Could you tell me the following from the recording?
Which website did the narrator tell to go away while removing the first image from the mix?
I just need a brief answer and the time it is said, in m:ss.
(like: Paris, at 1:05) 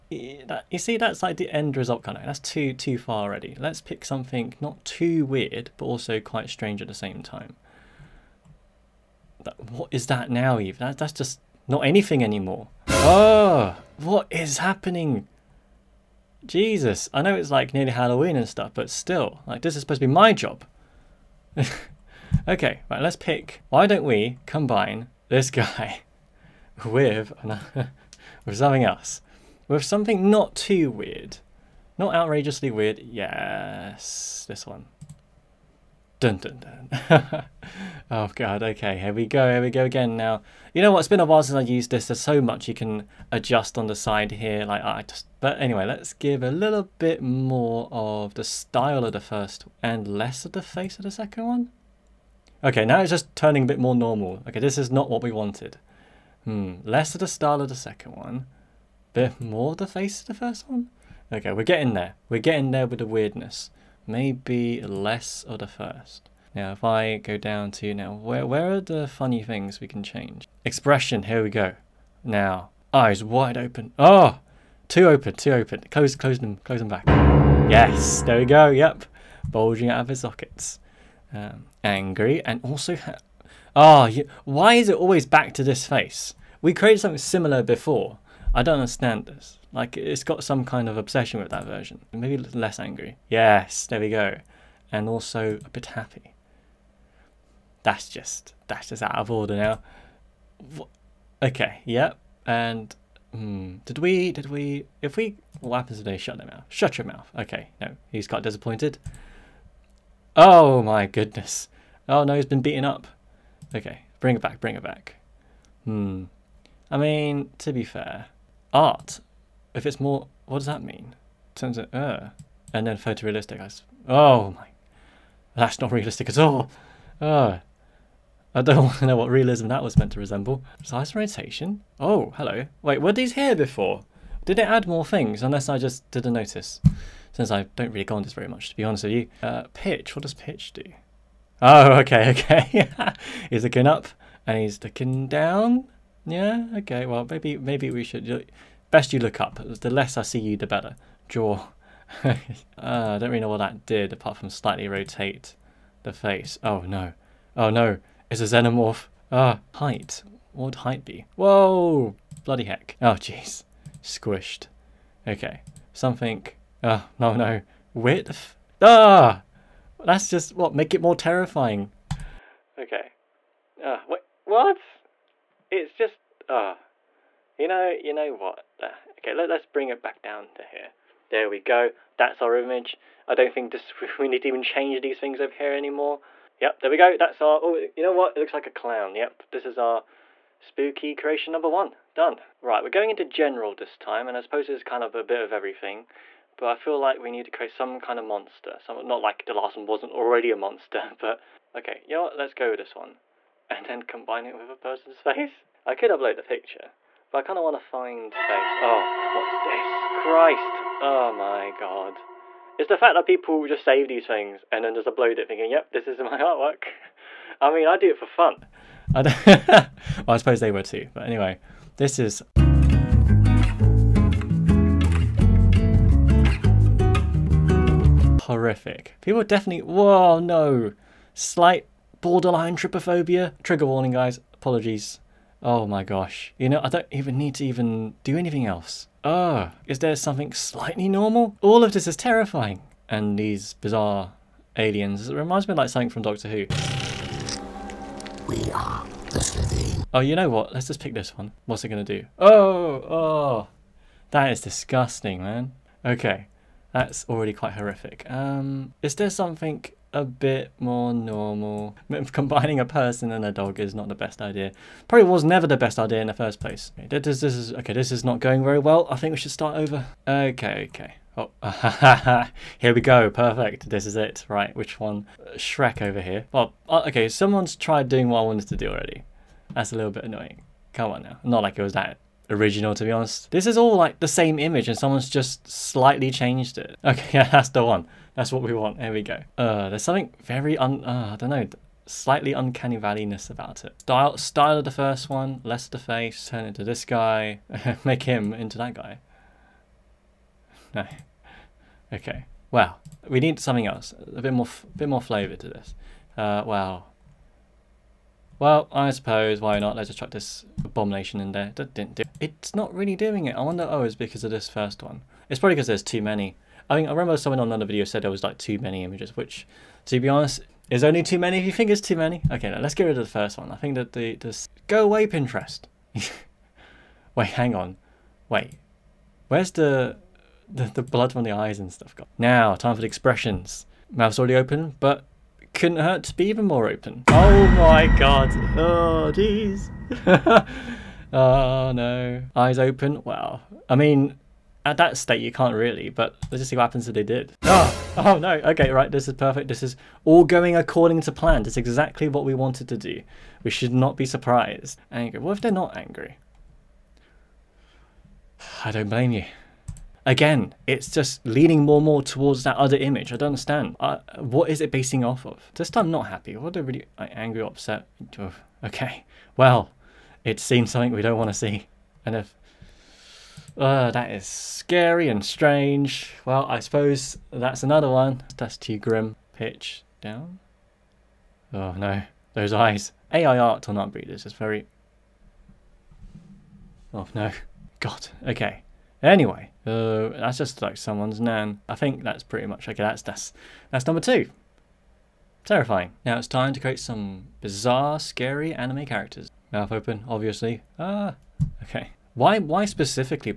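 Pinterest, at 5:25.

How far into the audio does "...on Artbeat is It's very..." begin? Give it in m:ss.
6:23.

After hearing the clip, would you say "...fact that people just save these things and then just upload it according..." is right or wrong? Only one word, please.
wrong.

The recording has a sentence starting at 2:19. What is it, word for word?
Uh, pitch, what does pitch do?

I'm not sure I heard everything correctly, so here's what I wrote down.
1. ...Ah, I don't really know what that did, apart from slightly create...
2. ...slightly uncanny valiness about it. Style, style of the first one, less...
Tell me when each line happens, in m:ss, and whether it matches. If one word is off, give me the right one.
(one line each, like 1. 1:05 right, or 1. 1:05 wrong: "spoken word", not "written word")
1. 2:32 wrong: "rotate", not "create"
2. 4:52 right.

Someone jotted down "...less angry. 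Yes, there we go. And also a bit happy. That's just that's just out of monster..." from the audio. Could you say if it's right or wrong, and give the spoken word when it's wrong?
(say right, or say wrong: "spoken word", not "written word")
wrong: "order", not "monster".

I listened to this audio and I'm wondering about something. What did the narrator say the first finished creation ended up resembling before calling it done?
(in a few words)
A clown.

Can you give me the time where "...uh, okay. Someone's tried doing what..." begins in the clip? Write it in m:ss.
4:36.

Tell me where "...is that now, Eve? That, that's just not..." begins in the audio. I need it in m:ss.
0:09.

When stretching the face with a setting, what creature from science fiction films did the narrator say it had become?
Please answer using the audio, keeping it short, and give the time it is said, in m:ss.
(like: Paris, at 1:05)
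Xenomorph, at 2:38.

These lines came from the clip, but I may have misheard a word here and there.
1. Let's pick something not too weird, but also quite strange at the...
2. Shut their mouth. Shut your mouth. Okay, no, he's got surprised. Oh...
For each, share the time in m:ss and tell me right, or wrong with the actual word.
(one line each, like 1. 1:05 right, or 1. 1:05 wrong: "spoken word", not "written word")
1. 0:03 right
2. 1:46 wrong: "disappointed", not "surprised".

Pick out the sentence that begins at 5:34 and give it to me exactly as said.
Mouth's already open, but couldn't hurt to be even more open.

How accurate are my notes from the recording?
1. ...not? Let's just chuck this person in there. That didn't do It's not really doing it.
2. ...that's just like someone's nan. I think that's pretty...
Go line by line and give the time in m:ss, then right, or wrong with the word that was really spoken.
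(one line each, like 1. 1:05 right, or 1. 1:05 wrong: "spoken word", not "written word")
1. 5:09 wrong: "abomination", not "person"
2. 6:30 right.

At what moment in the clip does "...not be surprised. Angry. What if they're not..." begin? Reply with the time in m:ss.
5:53.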